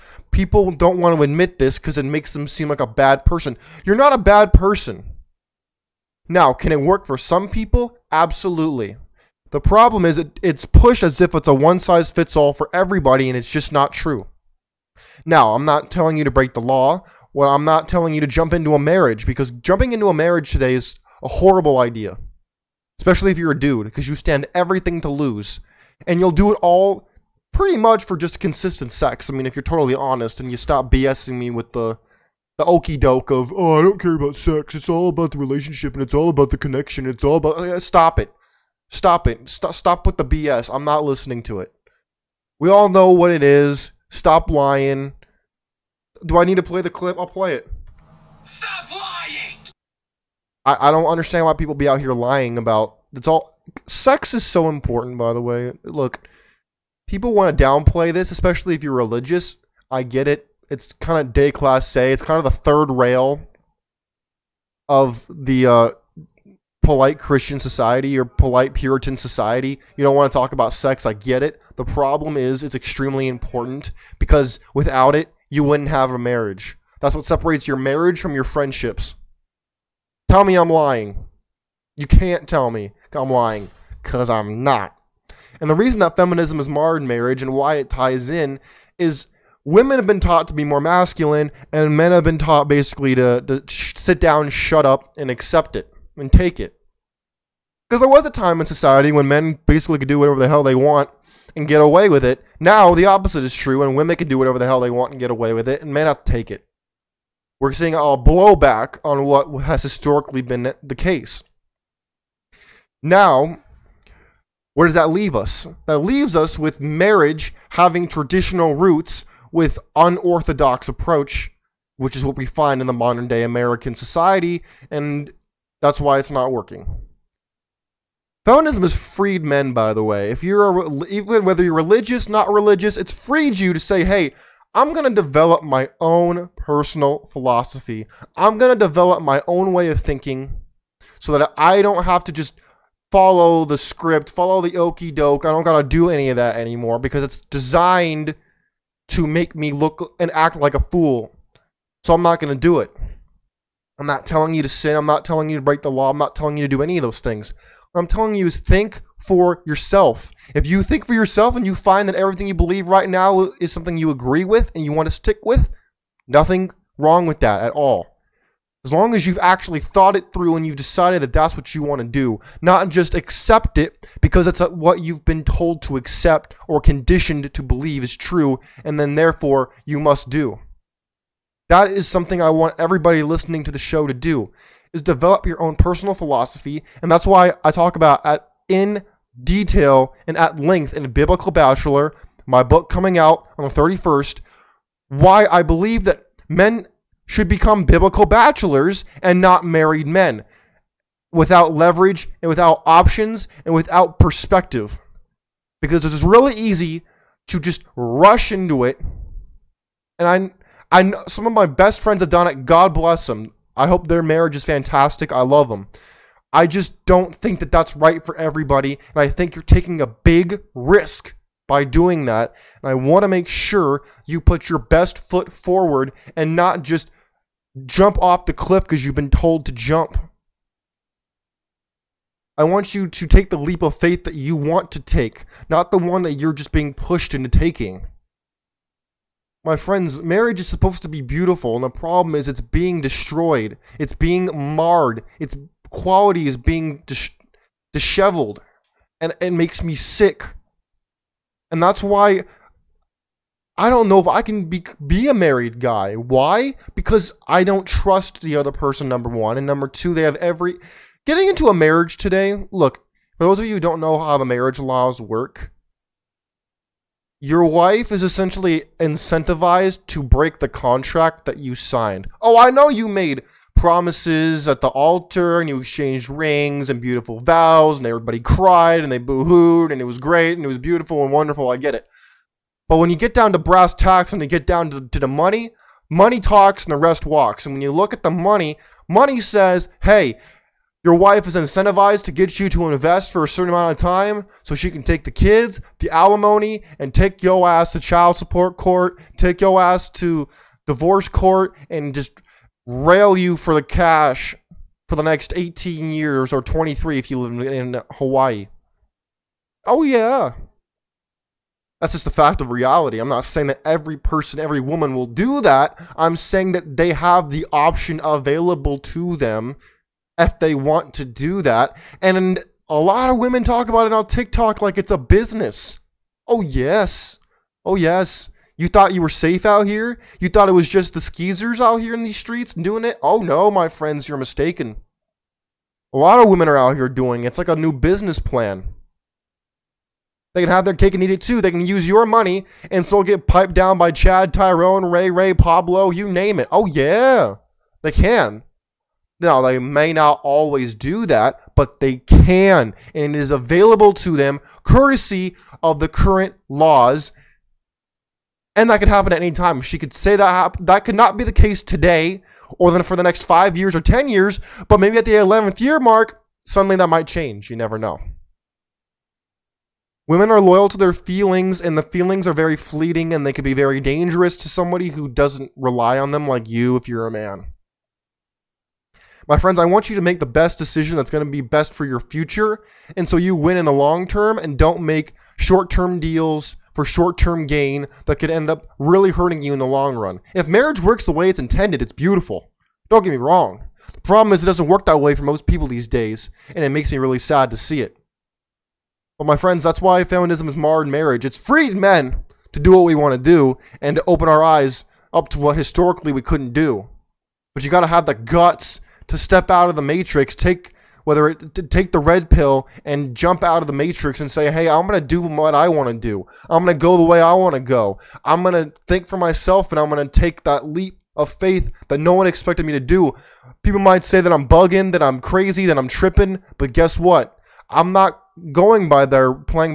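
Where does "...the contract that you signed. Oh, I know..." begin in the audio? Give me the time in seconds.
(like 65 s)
270 s.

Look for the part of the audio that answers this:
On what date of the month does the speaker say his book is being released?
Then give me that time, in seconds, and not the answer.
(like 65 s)
193 s.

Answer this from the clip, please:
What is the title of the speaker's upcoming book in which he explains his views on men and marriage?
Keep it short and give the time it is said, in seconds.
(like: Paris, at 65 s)
Biblical Bachelor, at 191 s.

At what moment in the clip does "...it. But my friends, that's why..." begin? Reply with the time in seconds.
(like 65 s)
398 s.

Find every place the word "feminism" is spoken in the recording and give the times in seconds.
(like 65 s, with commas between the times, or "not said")
86 s, 128 s, 400 s.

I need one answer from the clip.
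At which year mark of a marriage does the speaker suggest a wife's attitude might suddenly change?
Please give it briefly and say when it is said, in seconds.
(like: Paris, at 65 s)
11th year, at 365 s.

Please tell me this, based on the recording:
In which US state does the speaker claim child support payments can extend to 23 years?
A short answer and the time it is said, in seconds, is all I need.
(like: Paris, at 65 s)
Hawaii, at 308 s.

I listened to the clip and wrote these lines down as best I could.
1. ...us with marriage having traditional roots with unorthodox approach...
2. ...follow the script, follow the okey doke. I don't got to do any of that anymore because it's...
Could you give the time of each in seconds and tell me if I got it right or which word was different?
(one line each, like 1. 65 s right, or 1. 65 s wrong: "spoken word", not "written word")
1. 116 s right
2. 143 s right.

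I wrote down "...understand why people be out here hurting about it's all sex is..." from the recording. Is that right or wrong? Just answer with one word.
wrong.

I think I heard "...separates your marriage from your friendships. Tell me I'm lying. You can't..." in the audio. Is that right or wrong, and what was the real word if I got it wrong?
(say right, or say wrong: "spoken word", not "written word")
right.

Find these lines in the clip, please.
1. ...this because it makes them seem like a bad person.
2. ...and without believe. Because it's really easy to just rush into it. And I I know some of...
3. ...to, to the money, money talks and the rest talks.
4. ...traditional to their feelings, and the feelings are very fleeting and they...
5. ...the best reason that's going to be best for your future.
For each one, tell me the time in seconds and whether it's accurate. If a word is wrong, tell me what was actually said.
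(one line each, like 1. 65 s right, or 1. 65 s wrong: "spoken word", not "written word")
1. 1 s right
2. 203 s wrong: "perspective", not "believe"
3. 284 s wrong: "walks", not "talks"
4. 370 s wrong: "loyal", not "traditional"
5. 380 s wrong: "decision", not "reason".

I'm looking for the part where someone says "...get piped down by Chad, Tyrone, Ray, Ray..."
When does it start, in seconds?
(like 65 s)
343 s.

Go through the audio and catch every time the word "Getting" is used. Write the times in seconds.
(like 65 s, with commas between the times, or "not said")
261 s.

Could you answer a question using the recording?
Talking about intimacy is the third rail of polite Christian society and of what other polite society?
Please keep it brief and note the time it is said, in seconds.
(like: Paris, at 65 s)
Puritan, at 68 s.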